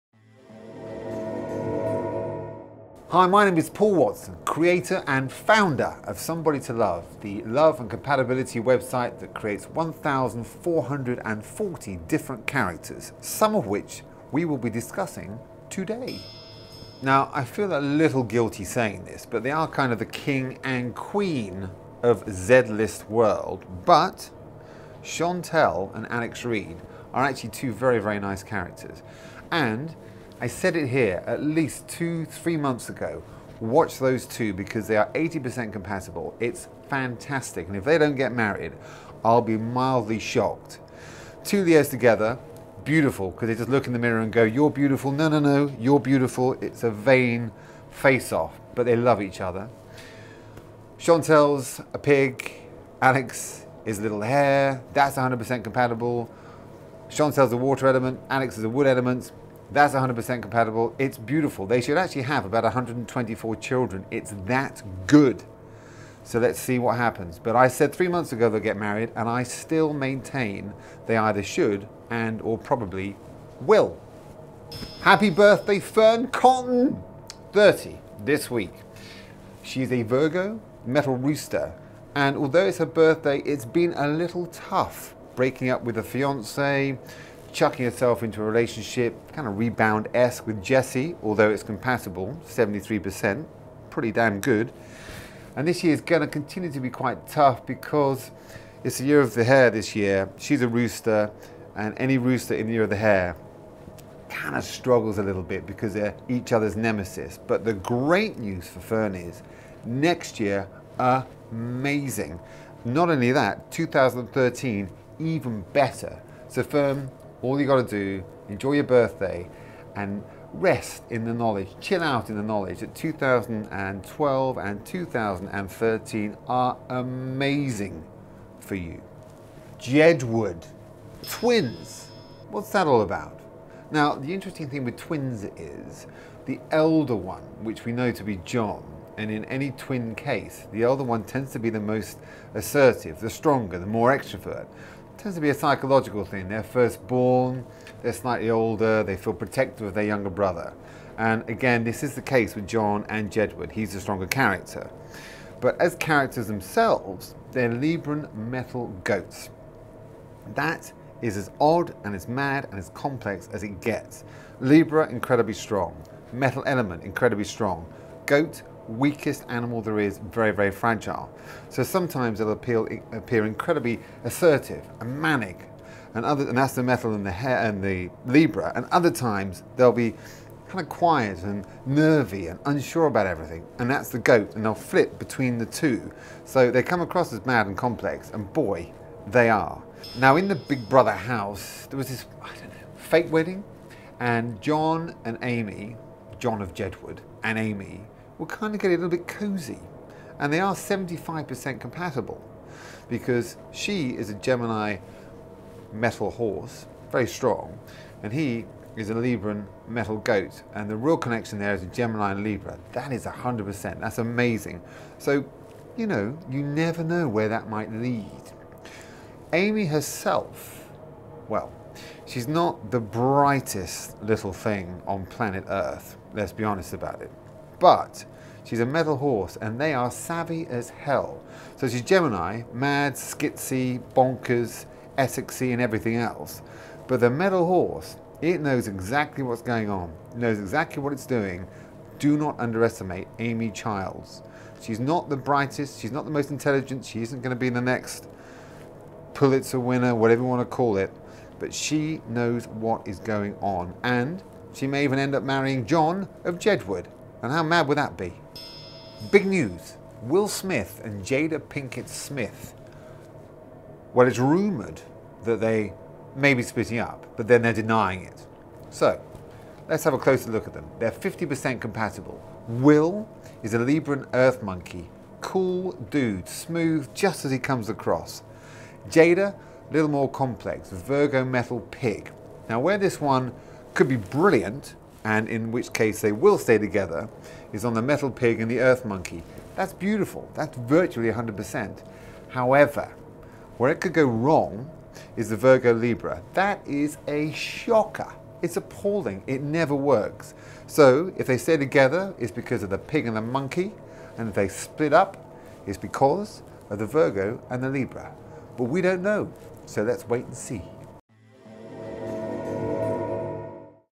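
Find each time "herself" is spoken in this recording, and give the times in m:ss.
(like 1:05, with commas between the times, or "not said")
1:27, 3:39.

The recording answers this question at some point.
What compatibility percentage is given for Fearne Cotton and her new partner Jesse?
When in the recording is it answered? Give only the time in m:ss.
1:32.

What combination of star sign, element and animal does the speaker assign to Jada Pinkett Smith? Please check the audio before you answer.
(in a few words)
Virgo metal pig.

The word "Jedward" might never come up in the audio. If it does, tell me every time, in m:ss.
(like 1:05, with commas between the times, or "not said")
2:09, 2:33, 3:16, 4:16.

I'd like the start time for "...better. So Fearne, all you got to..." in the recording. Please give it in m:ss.
1:55.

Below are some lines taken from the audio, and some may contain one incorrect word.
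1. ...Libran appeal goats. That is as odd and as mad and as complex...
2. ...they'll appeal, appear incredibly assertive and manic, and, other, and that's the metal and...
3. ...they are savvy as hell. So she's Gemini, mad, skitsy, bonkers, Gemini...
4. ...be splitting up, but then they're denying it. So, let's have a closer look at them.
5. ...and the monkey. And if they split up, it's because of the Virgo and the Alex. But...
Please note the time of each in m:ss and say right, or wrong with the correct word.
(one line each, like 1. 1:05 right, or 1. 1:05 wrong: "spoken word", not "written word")
1. 2:37 wrong: "metal", not "appeal"
2. 2:52 right
3. 3:49 wrong: "Essexy", not "Gemini"
4. 4:26 right
5. 5:03 wrong: "Libra", not "Alex".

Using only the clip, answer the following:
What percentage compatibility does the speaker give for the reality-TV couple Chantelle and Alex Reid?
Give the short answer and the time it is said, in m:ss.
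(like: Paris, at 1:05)
80%, at 0:35.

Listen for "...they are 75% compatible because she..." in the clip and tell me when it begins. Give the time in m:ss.
3:20.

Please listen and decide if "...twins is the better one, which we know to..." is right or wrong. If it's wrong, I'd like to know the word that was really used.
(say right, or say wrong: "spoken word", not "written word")
wrong: "elder", not "better".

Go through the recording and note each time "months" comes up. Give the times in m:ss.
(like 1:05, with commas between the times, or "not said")
0:32, 1:08.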